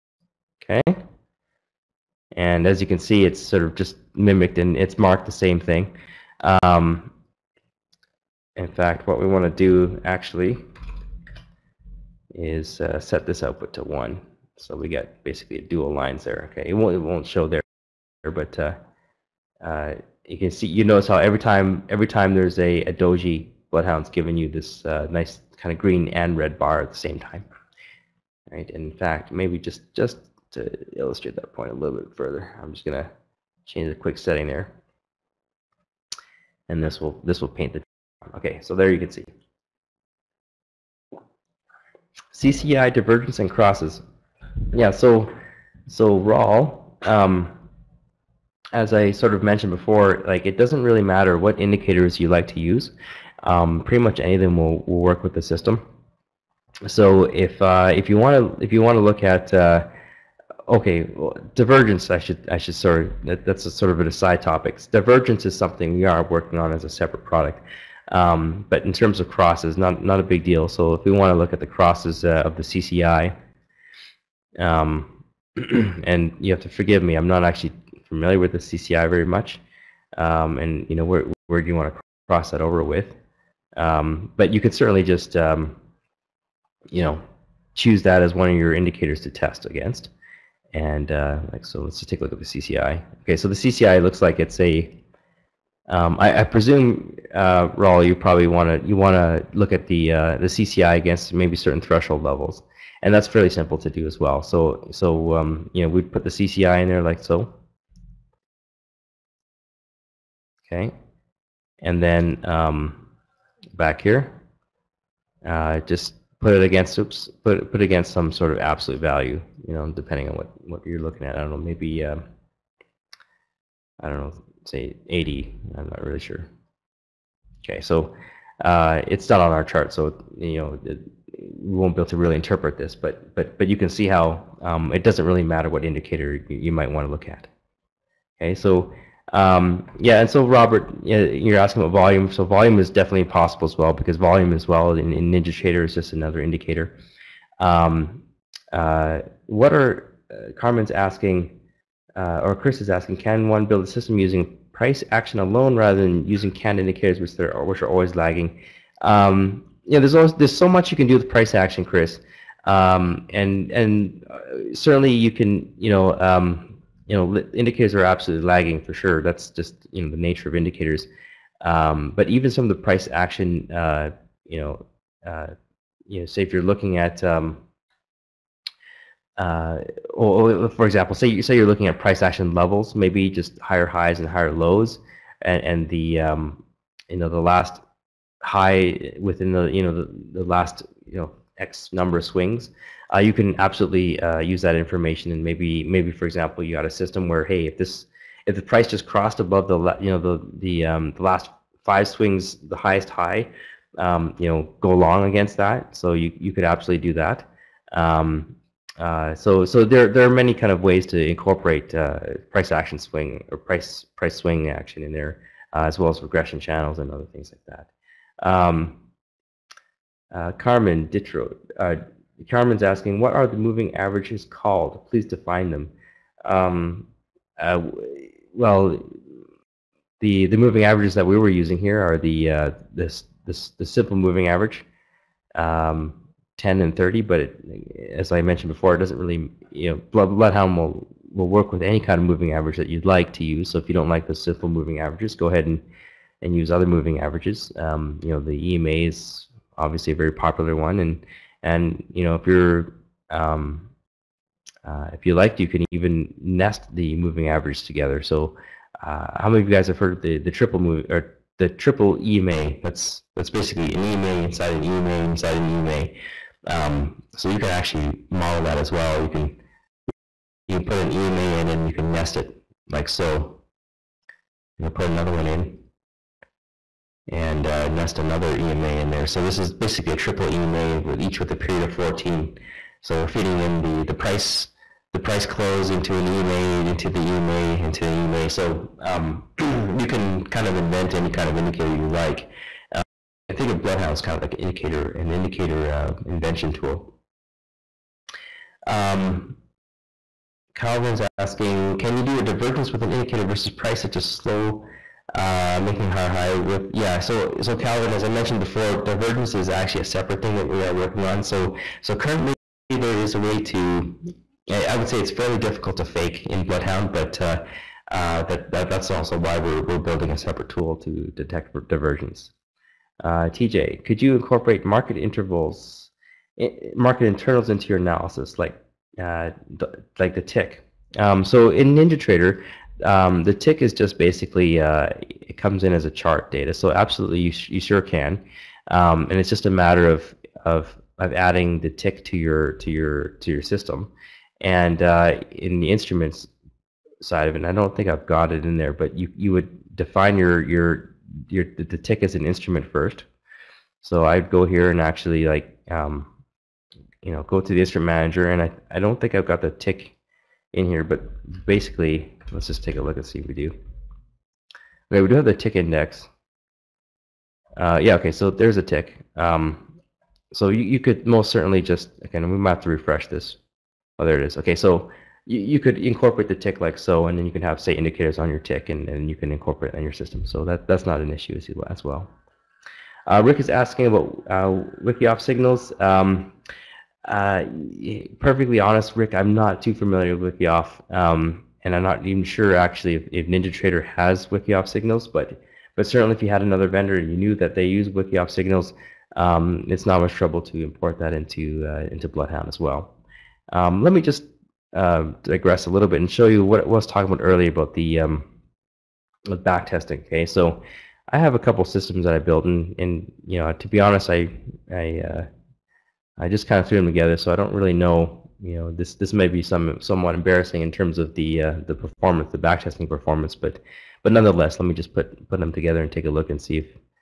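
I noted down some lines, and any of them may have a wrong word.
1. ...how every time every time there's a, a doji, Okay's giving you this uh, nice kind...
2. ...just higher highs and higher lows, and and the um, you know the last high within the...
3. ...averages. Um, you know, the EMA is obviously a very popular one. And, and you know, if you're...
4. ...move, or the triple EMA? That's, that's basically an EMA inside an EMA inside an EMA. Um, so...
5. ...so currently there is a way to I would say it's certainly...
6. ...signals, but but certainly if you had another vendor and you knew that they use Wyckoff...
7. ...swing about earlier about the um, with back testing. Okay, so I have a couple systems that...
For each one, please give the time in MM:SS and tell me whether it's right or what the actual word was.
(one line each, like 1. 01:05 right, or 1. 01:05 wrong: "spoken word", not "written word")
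1. 00:21 wrong: "Bloodhound", not "Okay"
2. 03:03 right
3. 04:07 right
4. 04:20 right
5. 05:12 wrong: "fairly", not "certainly"
6. 06:34 right
7. 06:47 wrong: "talking", not "swing".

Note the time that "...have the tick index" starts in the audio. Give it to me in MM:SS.
06:05.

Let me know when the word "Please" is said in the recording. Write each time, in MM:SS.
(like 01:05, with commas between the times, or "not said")
03:45.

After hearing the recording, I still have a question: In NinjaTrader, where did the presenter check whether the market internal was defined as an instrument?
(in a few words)
Instrument manager.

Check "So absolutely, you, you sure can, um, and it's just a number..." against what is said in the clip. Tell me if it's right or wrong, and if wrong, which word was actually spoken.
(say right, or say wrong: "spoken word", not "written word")
wrong: "matter", not "number".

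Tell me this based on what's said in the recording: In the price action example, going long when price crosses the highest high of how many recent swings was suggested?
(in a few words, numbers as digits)
5.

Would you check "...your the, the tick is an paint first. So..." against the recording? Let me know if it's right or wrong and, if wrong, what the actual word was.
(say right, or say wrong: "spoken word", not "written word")
wrong: "instrument", not "paint".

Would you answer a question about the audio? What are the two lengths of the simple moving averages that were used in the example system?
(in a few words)
10 and 30.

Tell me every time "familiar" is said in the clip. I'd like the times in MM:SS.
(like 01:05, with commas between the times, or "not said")
01:18, 06:29.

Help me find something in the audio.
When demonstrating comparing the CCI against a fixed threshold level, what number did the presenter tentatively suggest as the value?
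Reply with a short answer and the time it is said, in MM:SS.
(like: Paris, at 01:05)
80, at 02:05.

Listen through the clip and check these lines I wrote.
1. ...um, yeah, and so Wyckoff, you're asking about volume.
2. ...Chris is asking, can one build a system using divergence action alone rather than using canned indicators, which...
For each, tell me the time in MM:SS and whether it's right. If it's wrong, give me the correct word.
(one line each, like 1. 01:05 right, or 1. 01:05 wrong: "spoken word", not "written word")
1. 02:19 wrong: "Robert", not "Wyckoff"
2. 02:32 wrong: "price", not "divergence".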